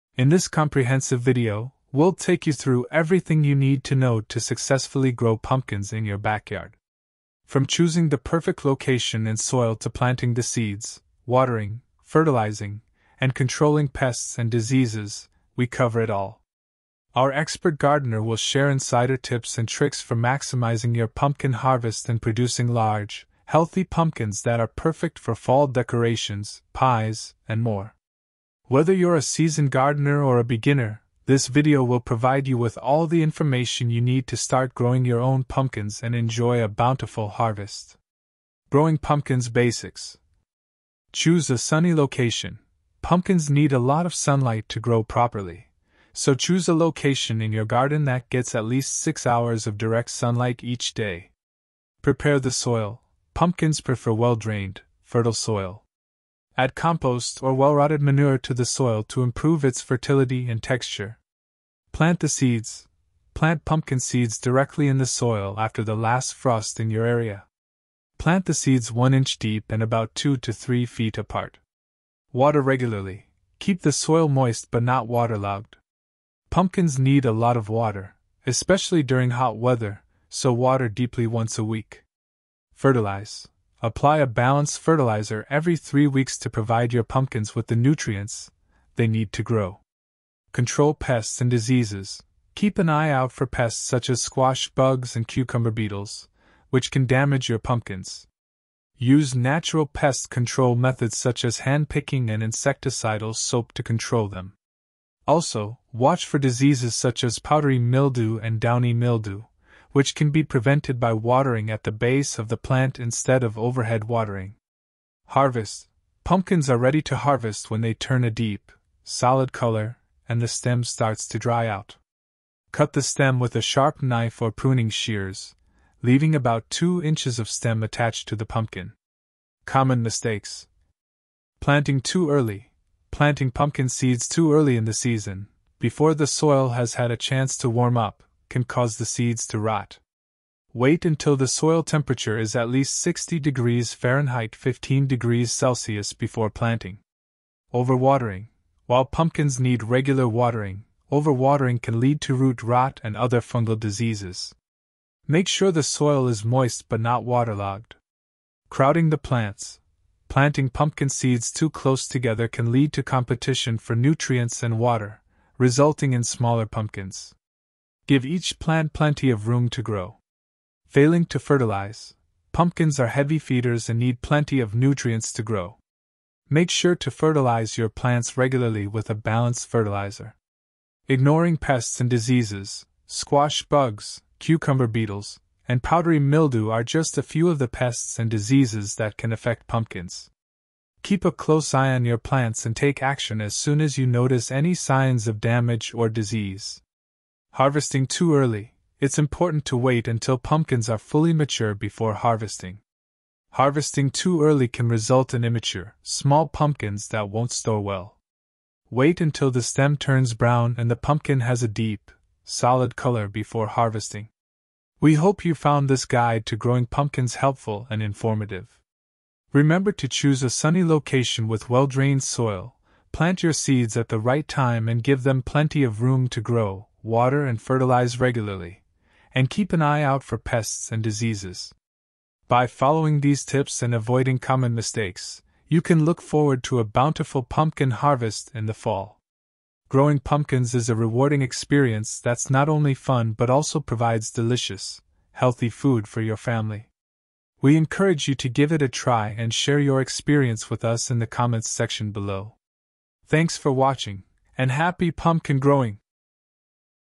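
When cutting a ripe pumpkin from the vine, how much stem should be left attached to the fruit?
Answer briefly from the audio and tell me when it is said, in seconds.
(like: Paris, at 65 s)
2 inches, at 126 s.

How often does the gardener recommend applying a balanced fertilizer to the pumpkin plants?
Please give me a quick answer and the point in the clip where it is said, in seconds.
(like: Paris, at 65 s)
Every three weeks, at 85 s.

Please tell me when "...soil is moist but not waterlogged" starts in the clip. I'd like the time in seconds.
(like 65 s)
155 s.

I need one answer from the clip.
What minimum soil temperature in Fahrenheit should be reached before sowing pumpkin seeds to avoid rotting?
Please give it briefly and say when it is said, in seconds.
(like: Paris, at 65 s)
60 degrees Fahrenheit, at 142 s.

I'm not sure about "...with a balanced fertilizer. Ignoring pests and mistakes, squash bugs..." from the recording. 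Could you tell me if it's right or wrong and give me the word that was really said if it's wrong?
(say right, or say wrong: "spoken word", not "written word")
wrong: "diseases", not "mistakes".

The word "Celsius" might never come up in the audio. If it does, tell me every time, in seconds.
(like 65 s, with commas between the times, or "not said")
145 s.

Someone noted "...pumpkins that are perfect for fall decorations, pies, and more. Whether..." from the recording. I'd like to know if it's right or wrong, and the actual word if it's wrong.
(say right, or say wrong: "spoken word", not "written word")
right.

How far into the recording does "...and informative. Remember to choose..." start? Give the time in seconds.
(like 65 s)
217 s.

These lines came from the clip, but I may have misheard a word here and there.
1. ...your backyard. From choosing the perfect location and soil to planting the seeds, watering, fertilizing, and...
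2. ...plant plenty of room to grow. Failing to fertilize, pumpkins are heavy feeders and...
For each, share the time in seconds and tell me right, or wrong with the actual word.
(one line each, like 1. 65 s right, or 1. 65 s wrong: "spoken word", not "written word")
1. 6 s right
2. 168 s right.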